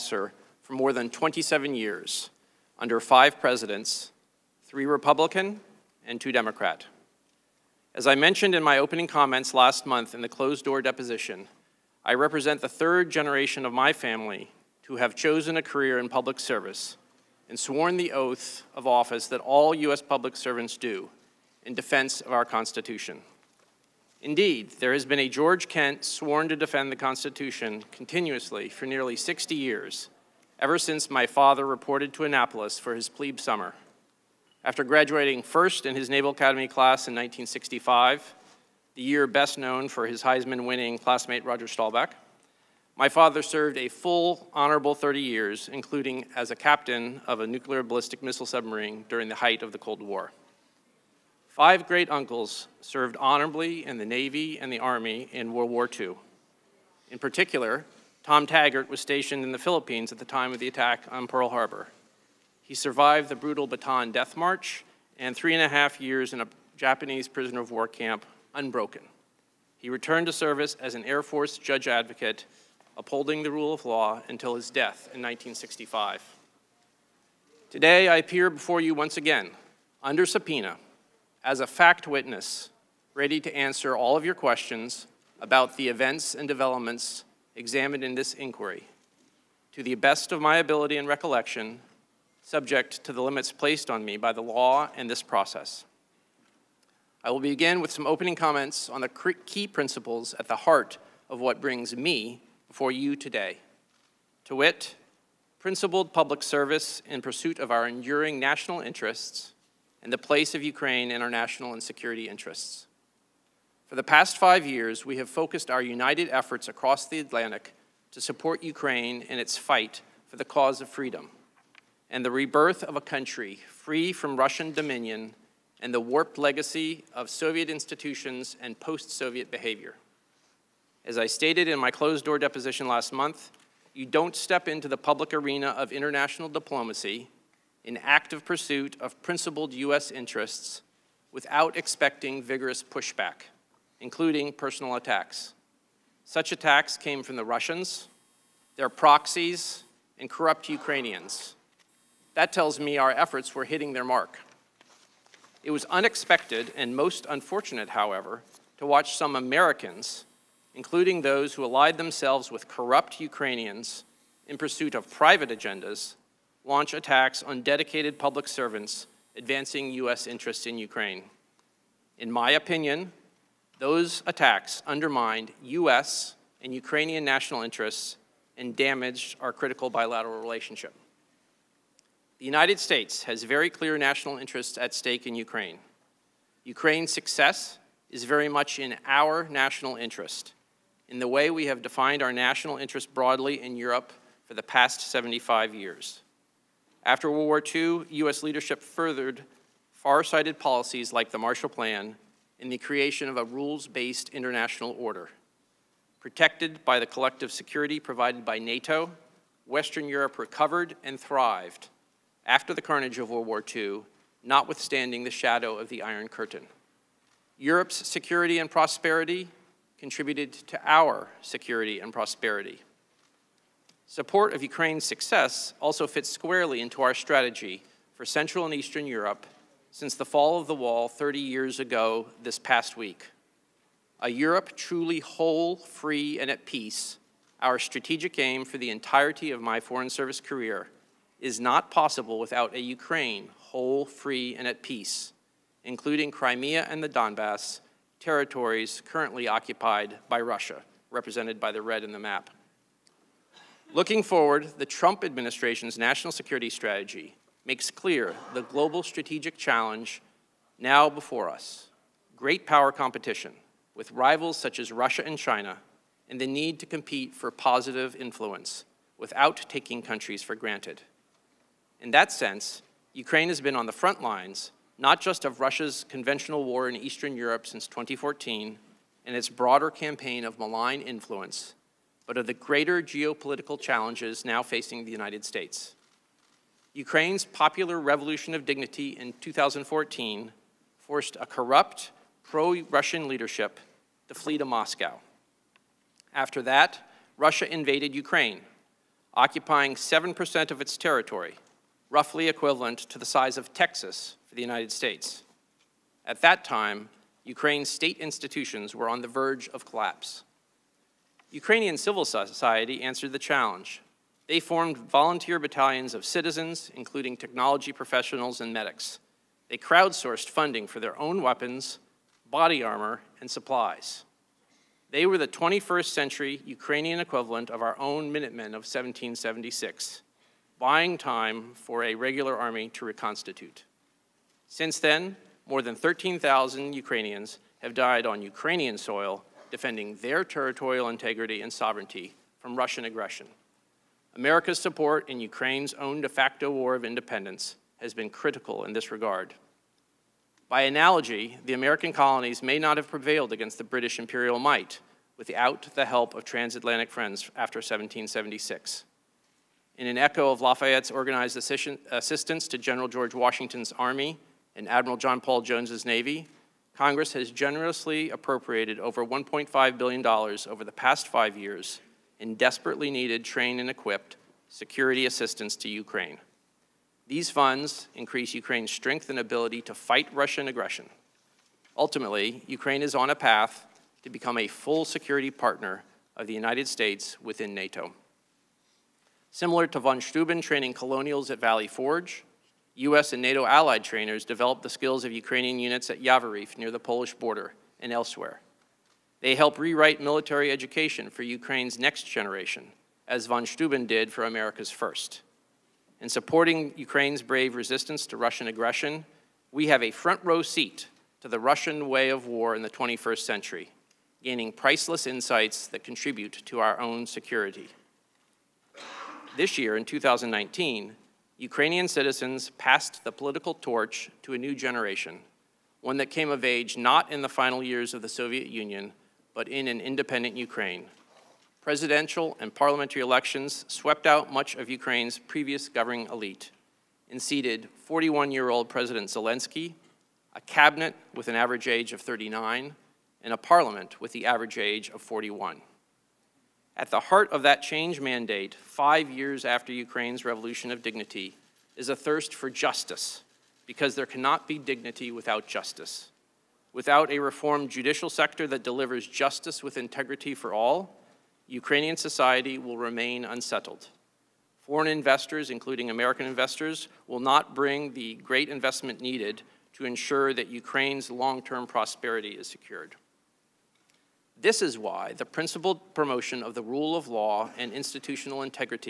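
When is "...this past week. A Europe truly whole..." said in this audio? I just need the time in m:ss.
3:52.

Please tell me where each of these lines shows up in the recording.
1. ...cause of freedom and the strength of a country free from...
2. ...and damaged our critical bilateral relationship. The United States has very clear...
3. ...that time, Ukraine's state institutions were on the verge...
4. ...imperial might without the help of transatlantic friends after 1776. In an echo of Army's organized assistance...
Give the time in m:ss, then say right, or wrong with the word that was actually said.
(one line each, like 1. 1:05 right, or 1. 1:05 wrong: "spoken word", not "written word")
1. 2:00 wrong: "rebirth", not "strength"
2. 2:58 right
3. 5:06 right
4. 5:54 wrong: "Lafayette", not "Army".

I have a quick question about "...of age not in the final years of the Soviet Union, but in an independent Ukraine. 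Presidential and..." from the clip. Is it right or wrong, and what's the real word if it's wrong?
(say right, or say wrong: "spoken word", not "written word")
right.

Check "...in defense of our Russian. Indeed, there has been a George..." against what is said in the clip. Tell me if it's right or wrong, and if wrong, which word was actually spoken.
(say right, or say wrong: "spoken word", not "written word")
wrong: "Constitution", not "Russian".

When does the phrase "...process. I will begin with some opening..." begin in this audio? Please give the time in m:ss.
1:35.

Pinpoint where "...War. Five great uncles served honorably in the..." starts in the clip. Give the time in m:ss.
0:50.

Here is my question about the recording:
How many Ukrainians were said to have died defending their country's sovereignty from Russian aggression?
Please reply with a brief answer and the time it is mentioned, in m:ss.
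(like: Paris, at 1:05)
13,000, at 5:35.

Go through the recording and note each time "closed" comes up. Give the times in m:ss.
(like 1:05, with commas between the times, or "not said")
0:10, 2:11.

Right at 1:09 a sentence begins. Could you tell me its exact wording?
He returned to service as an Air Force judge advocate upholding the rule of law until his death in 1965.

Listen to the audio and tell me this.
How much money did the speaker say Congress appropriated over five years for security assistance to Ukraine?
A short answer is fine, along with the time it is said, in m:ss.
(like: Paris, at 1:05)
$1.5 billion, at 6:09.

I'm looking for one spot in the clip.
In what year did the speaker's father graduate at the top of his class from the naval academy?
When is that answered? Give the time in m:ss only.
0:37.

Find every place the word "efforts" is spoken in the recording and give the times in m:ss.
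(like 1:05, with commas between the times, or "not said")
1:56, 2:33.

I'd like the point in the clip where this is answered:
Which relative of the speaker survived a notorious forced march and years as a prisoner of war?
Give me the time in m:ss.
0:58.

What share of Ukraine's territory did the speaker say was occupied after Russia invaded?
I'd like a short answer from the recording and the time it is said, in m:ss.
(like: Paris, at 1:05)
7%, at 4:59.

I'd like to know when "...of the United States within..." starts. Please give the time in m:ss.
6:26.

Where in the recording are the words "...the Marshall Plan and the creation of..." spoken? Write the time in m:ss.
3:21.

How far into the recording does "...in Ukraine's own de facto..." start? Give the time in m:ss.
5:45.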